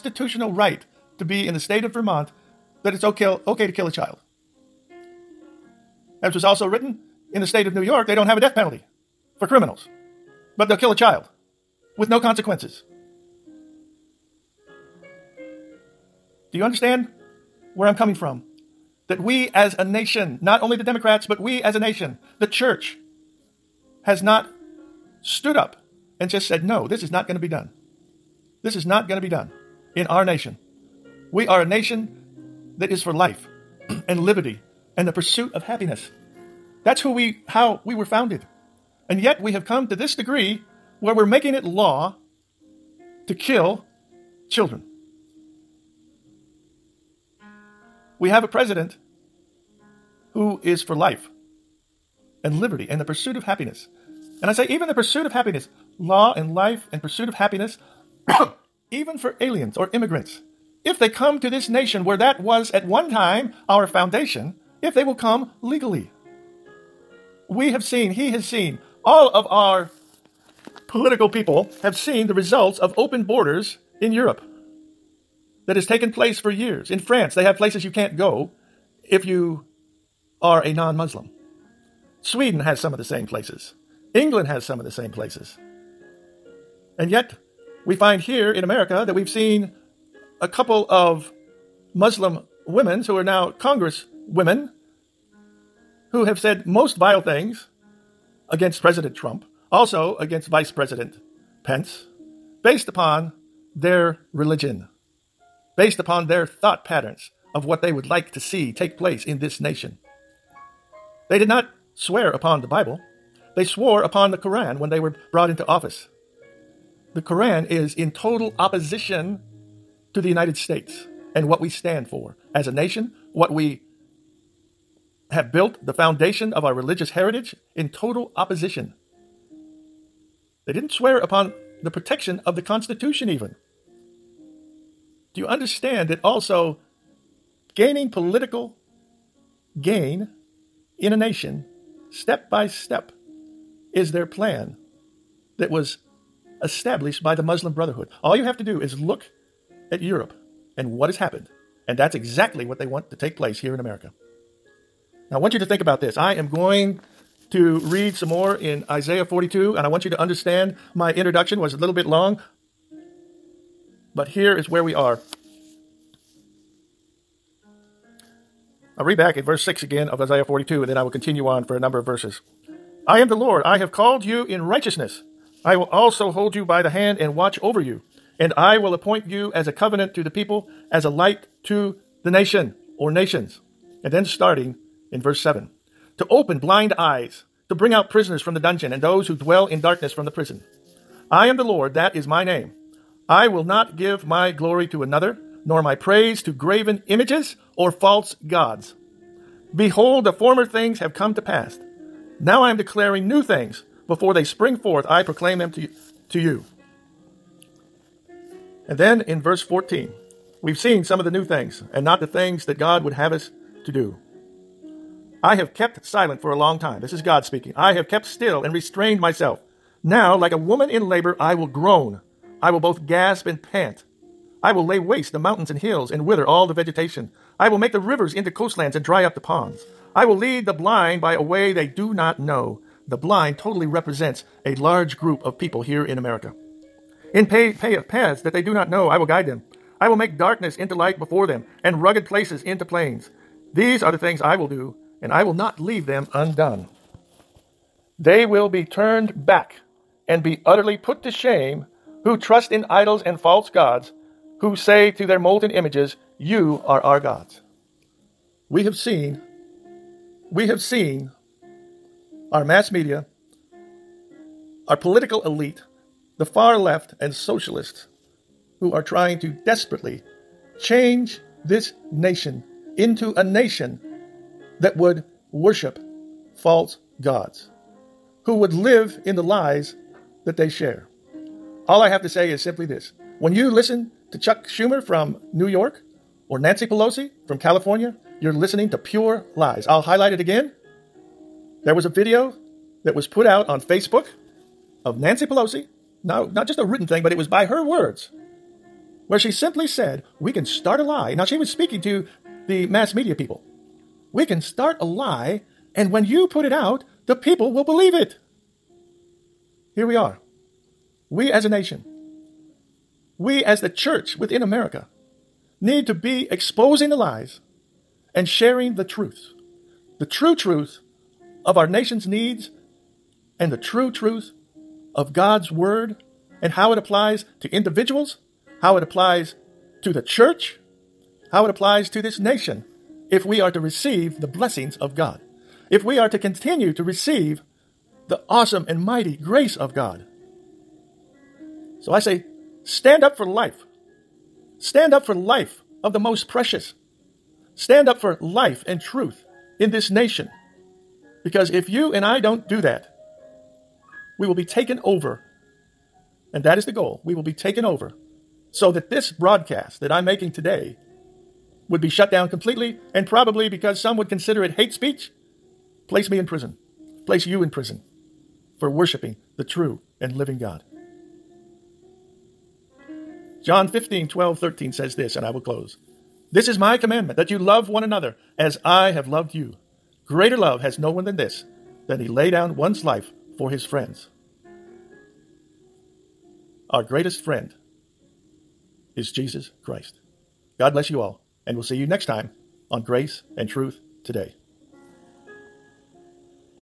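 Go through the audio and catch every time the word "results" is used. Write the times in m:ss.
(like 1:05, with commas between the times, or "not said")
1:12.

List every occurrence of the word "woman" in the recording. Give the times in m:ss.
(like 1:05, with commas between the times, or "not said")
3:40.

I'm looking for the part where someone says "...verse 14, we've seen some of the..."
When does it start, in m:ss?
3:29.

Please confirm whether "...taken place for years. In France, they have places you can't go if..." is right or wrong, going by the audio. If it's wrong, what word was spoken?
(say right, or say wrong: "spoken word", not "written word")
right.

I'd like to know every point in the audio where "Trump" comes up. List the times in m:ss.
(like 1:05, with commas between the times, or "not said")
1:39.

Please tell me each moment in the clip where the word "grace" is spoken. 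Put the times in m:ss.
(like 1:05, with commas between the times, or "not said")
5:39, 6:33.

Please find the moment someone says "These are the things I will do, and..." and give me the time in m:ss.
4:03.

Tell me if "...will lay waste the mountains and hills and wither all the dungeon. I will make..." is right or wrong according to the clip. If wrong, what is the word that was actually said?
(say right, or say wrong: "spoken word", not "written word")
wrong: "vegetation", not "dungeon".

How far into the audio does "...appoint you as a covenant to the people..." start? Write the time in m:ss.
2:58.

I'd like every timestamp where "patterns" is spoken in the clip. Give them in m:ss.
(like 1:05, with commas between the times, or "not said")
1:46.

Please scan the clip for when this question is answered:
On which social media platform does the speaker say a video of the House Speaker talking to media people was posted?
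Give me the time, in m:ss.
4:53.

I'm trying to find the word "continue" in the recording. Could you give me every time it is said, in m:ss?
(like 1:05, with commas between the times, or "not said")
2:51, 5:36.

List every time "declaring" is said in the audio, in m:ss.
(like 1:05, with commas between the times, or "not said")
3:22.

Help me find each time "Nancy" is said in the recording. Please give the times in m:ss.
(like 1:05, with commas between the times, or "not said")
4:46, 4:55.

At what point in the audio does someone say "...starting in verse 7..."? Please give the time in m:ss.
3:04.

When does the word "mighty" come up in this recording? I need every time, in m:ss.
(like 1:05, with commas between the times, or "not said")
5:39.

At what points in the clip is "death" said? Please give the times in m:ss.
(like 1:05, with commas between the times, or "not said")
0:08.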